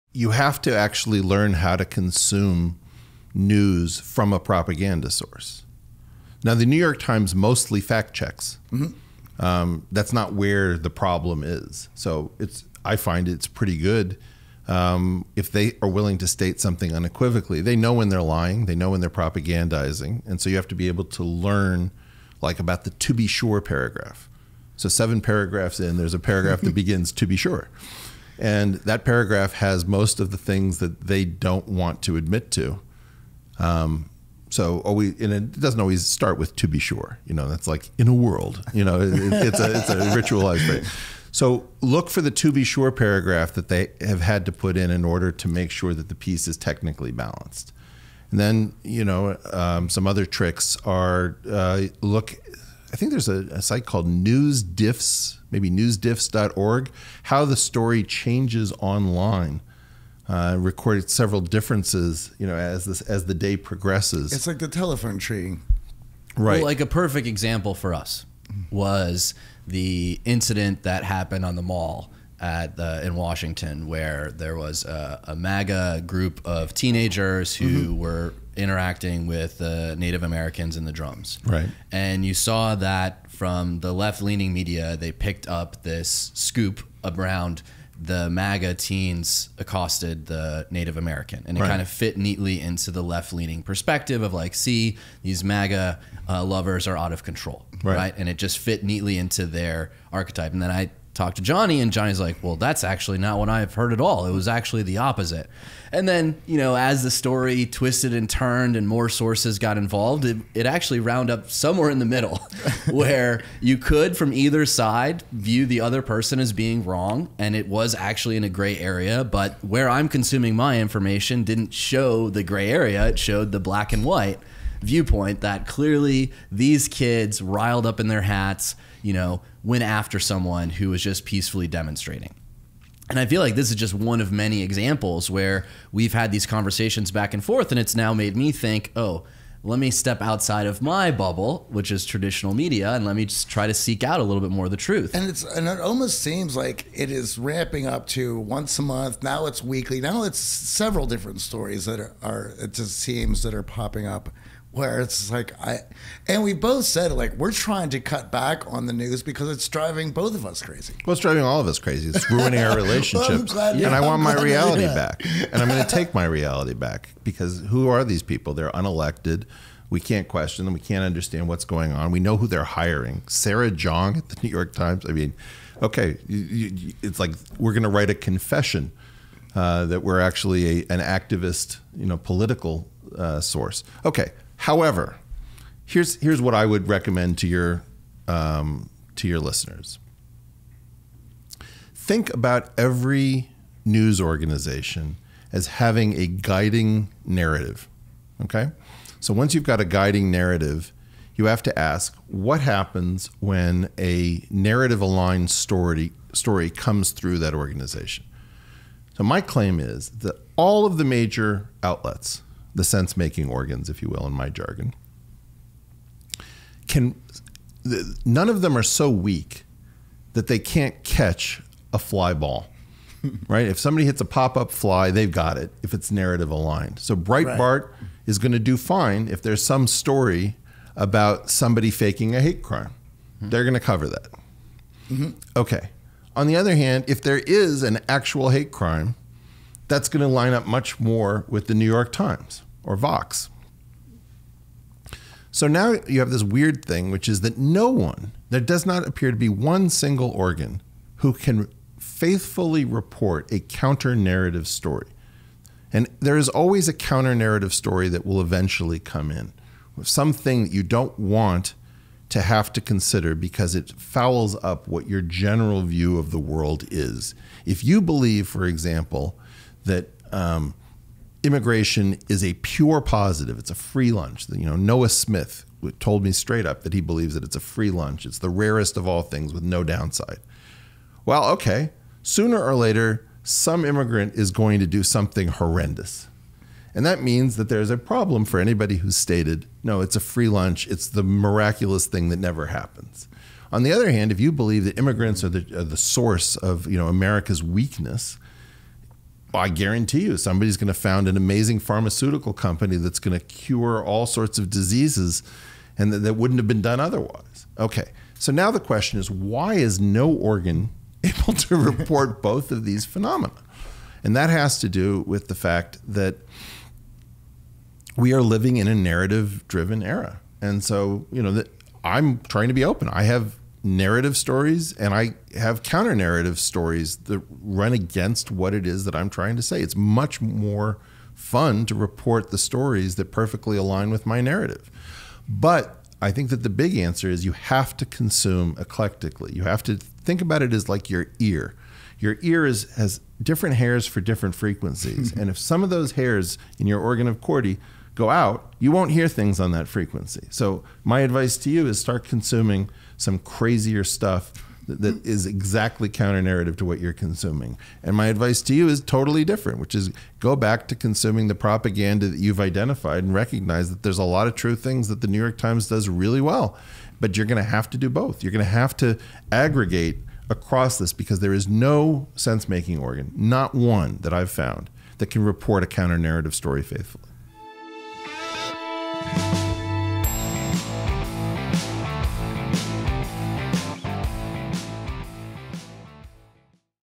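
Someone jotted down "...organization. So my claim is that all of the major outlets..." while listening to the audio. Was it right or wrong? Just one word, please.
right.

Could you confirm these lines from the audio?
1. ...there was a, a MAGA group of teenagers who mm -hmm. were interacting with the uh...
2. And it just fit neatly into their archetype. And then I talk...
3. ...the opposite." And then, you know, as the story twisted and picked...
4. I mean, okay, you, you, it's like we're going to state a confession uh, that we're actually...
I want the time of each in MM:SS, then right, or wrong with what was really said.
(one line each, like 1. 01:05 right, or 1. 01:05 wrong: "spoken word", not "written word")
1. 01:14 right
2. 01:38 right
3. 01:44 wrong: "turned", not "picked"
4. 02:55 wrong: "write", not "state".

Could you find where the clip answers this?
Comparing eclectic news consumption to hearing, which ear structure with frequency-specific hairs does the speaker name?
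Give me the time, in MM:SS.
05:46.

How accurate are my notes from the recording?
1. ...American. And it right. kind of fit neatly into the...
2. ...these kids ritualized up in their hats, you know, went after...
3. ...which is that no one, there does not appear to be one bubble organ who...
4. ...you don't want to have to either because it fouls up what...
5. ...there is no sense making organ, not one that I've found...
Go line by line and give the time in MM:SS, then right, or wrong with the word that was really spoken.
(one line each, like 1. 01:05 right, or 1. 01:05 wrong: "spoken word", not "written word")
1. 01:30 right
2. 02:06 wrong: "riled", not "ritualized"
3. 04:07 wrong: "single", not "bubble"
4. 04:20 wrong: "consider", not "either"
5. 06:11 right.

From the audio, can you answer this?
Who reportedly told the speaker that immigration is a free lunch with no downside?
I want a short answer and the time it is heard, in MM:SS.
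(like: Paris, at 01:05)
Noah Smith, at 04:34.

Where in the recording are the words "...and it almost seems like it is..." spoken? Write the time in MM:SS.
02:25.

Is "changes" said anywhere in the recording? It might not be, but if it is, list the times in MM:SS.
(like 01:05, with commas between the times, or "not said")
00:58.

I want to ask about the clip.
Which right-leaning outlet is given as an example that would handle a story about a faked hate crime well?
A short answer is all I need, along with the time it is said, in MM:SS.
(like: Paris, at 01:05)
Breitbart, at 03:47.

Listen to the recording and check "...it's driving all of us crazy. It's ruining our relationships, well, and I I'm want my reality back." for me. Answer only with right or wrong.
right.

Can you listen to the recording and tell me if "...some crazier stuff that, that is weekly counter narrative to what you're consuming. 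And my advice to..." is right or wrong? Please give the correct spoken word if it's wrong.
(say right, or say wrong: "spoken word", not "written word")
wrong: "exactly", not "weekly".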